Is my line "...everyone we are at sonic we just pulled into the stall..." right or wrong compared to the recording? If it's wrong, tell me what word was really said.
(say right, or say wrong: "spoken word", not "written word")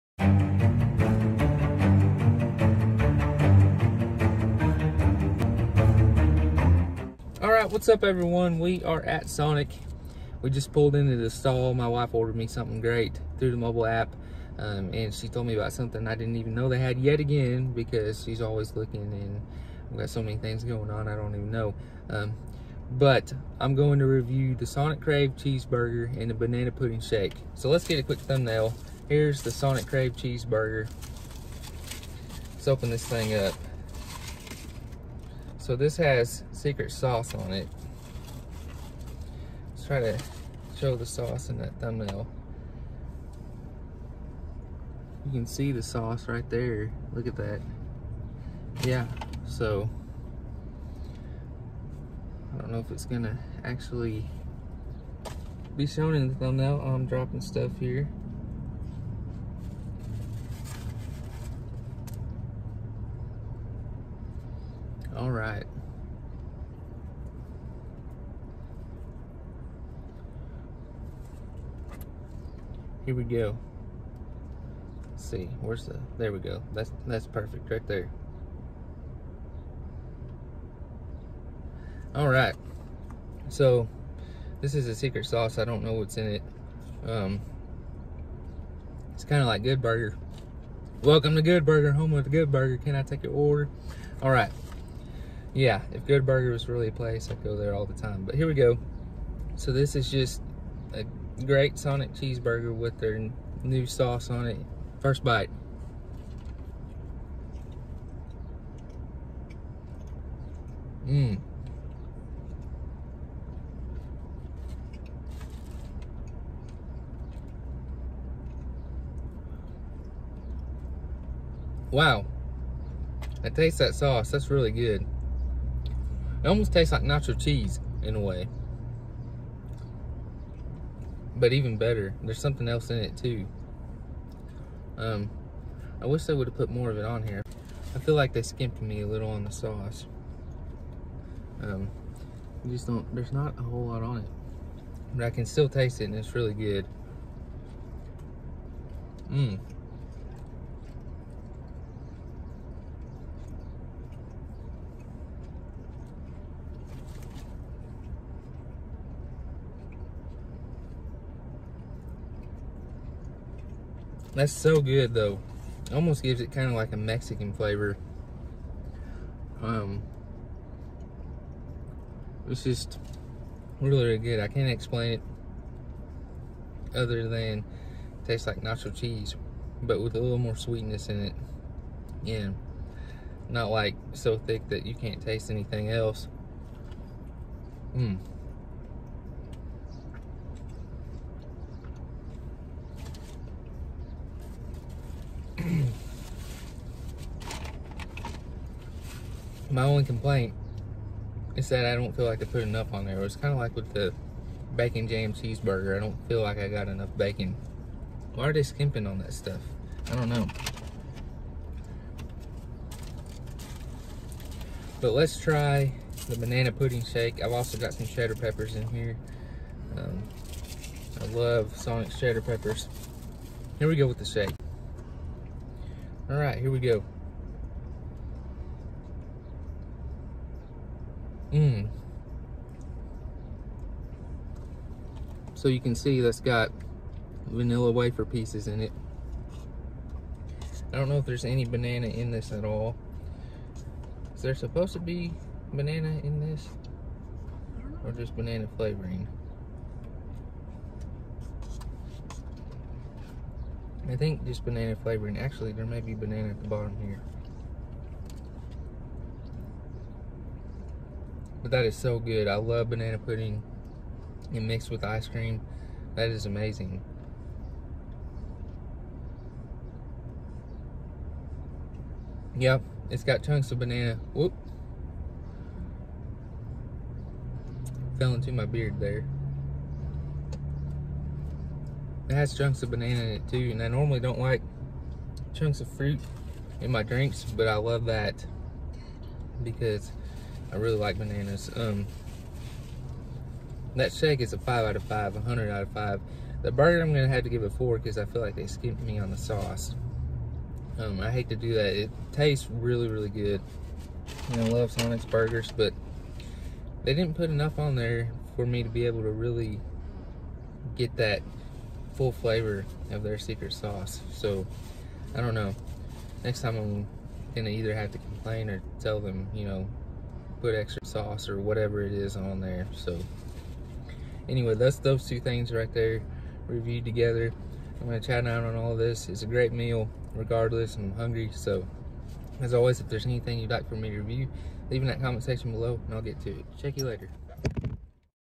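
right.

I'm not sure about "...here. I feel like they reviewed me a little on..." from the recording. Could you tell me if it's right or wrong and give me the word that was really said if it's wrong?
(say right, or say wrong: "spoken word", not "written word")
wrong: "skimped", not "reviewed".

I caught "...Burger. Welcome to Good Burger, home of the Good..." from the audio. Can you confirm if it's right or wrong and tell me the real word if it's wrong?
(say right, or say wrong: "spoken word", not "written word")
right.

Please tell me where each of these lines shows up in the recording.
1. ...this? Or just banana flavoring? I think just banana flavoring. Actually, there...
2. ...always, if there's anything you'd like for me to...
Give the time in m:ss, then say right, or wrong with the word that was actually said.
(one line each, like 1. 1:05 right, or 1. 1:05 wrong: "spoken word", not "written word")
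1. 4:06 right
2. 5:32 right.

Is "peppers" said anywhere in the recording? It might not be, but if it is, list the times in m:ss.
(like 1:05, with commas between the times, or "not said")
3:38, 3:42.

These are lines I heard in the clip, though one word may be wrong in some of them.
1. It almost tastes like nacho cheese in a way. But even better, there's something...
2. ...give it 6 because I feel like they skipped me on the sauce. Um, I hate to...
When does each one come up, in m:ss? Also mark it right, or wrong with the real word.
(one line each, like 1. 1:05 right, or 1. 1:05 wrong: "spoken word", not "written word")
1. 2:06 right
2. 4:57 wrong: "4", not "6".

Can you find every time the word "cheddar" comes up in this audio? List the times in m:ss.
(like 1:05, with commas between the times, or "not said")
3:38, 3:42.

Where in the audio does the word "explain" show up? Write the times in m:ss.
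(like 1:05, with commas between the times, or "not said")
2:54.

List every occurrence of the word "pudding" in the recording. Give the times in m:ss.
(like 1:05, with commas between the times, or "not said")
0:26, 3:36, 4:23.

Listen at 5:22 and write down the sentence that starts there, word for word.
So anyway, that's those two things right there reviewed together.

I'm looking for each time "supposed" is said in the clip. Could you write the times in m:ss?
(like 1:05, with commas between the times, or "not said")
4:04.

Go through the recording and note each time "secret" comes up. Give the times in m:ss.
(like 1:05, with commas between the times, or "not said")
0:36, 1:24, 5:13.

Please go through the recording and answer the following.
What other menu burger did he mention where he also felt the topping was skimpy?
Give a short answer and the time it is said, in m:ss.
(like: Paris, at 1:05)
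Bacon jam cheeseburger, at 3:24.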